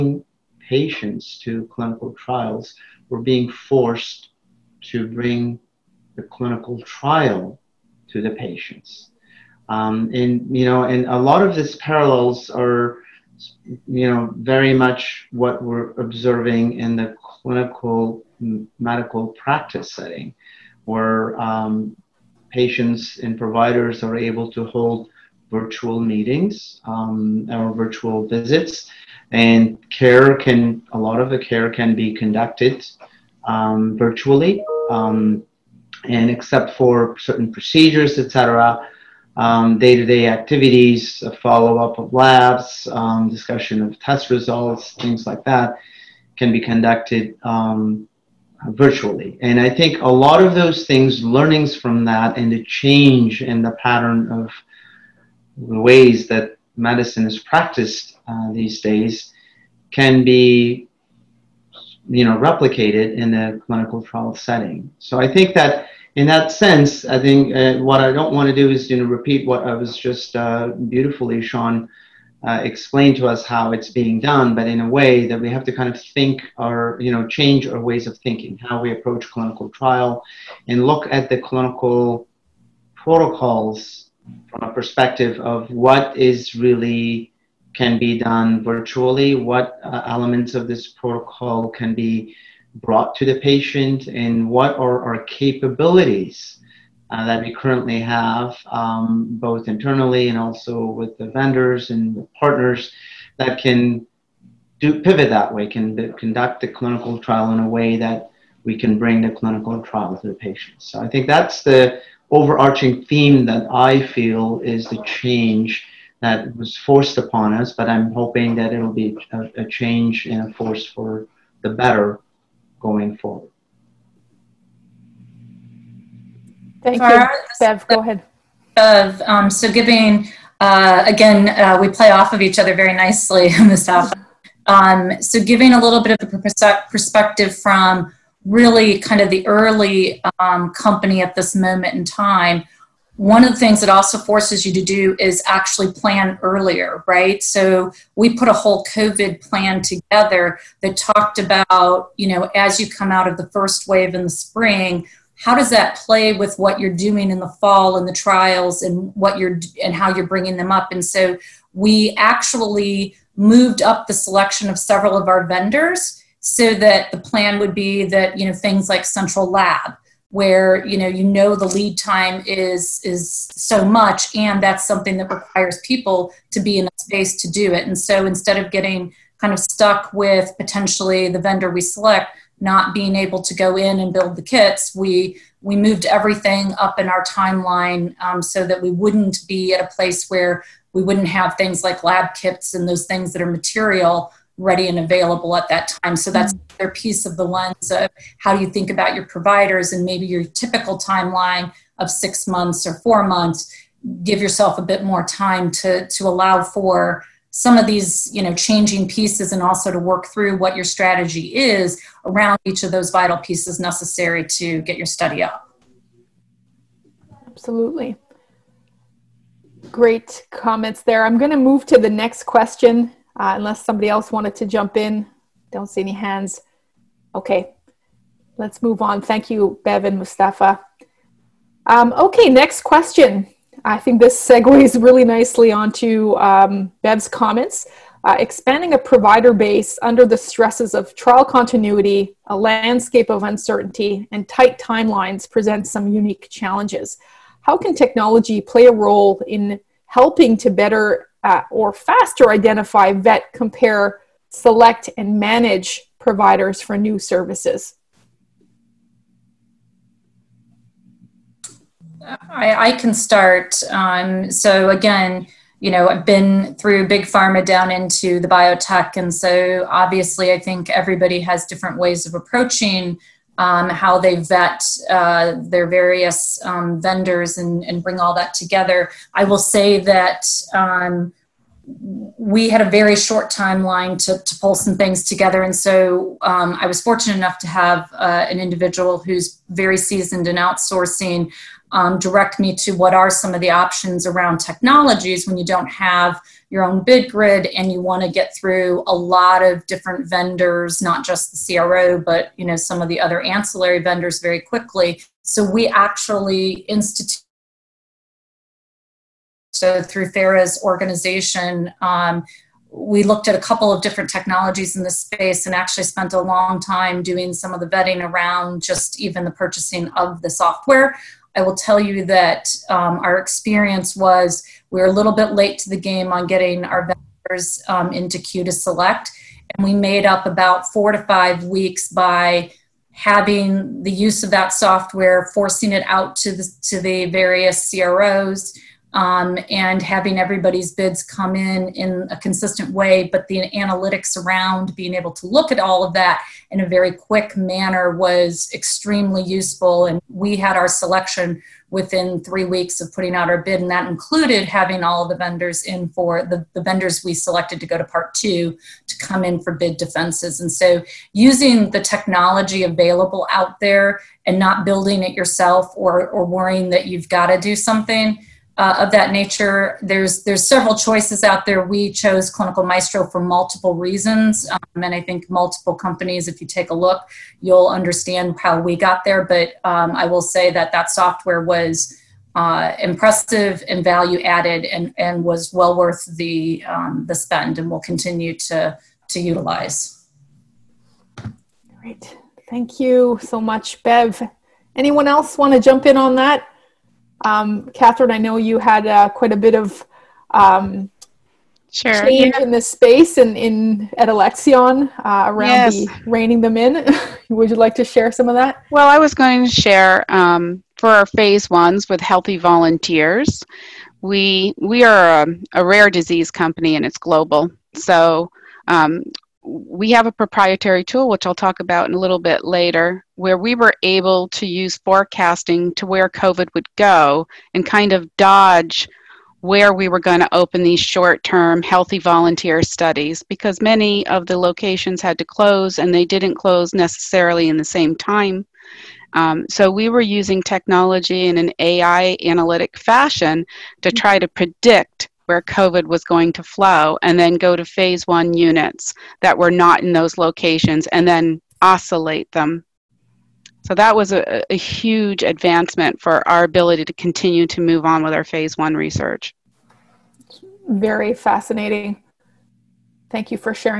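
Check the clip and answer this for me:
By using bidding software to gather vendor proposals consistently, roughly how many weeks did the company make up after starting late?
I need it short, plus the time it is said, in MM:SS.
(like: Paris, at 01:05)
4 to 5 weeks, at 05:30.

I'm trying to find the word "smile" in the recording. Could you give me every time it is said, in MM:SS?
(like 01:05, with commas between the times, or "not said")
not said.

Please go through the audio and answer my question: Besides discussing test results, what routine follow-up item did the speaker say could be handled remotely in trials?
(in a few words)
labs.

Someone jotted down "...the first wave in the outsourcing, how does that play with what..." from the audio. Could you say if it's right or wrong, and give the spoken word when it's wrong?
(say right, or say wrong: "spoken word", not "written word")
wrong: "spring", not "outsourcing".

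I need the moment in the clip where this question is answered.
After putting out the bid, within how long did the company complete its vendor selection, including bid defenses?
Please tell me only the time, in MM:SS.
05:52.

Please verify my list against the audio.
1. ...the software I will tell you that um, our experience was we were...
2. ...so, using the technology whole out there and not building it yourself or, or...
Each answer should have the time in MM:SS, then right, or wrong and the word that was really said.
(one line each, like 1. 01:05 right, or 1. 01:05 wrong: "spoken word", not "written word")
1. 05:20 right
2. 06:00 wrong: "available", not "whole".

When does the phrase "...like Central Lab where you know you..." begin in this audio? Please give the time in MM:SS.
02:48.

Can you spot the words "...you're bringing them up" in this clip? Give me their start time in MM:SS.
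02:40.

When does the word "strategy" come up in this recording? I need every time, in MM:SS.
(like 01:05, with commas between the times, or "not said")
03:30.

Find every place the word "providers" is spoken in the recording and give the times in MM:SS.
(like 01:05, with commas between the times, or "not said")
00:23, 03:19, 03:58, 04:16.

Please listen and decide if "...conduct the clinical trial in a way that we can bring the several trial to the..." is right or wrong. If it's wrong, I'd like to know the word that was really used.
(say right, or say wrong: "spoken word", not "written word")
wrong: "clinical", not "several".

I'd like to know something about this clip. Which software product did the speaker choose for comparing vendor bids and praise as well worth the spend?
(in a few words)
Clinical Maestro.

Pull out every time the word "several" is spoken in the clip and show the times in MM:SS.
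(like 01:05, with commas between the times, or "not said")
02:44, 06:10.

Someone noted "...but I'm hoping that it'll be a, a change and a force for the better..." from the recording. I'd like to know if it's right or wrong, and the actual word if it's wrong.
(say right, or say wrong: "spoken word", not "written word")
right.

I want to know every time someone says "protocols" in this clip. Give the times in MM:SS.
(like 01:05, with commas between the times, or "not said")
01:22, 01:30.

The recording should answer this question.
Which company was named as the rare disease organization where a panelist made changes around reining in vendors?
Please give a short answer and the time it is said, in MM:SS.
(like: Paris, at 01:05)
Alexion, at 06:44.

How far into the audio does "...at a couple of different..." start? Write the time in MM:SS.
05:13.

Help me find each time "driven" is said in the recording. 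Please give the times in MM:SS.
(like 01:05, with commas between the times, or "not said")
not said.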